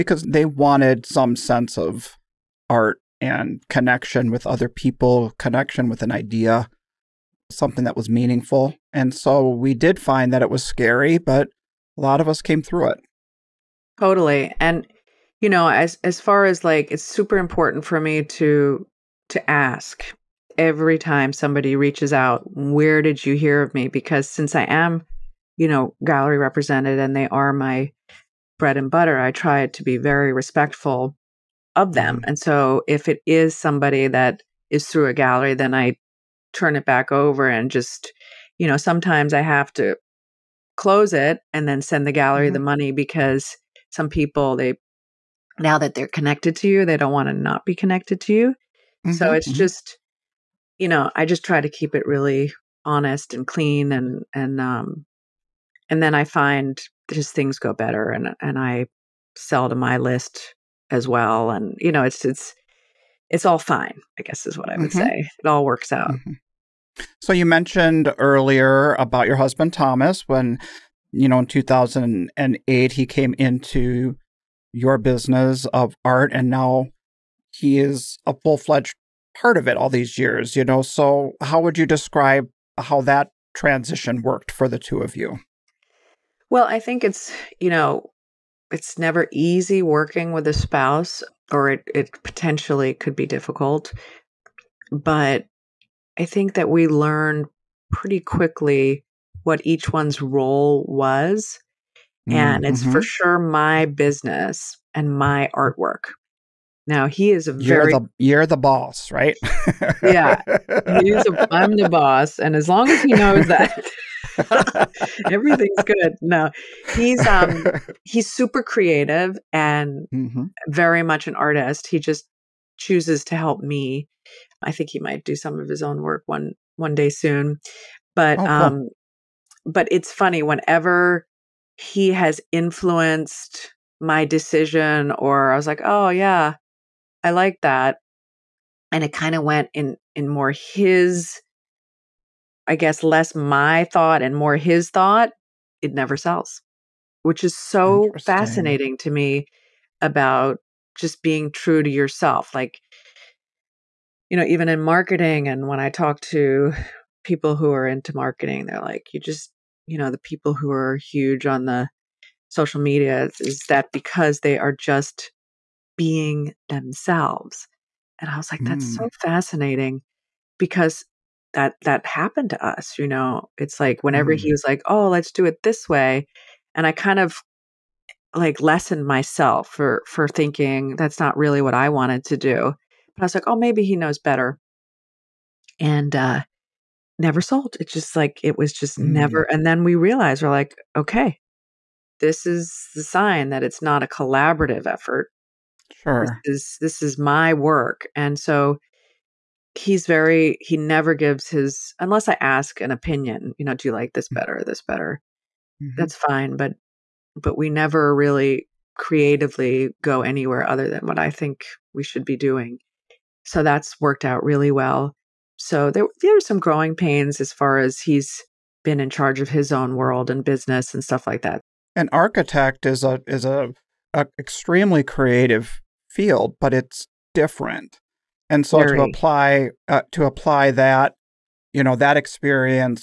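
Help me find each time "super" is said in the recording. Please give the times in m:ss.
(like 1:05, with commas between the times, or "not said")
0:17, 1:58.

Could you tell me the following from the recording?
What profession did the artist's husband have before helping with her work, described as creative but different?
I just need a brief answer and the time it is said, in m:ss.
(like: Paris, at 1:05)
Architect, at 3:41.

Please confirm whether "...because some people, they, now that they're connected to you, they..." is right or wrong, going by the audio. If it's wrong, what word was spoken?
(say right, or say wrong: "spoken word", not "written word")
right.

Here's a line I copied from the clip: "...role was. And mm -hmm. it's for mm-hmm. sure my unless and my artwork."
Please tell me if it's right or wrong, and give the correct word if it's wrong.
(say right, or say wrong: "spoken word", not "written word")
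wrong: "business", not "unless".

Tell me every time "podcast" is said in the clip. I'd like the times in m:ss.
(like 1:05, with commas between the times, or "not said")
not said.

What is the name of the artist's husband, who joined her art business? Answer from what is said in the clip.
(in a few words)
Thomas.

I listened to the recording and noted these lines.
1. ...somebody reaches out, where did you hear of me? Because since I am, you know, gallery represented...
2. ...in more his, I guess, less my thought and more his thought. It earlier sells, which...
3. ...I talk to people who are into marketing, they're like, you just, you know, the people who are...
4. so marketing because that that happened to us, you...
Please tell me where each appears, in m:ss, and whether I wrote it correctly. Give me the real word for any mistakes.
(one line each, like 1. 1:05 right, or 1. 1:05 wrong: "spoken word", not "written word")
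1. 0:21 right
2. 2:20 wrong: "never", not "earlier"
3. 2:35 right
4. 2:48 wrong: "fascinating", not "marketing".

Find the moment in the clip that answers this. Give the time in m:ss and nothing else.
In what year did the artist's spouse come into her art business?
1:11.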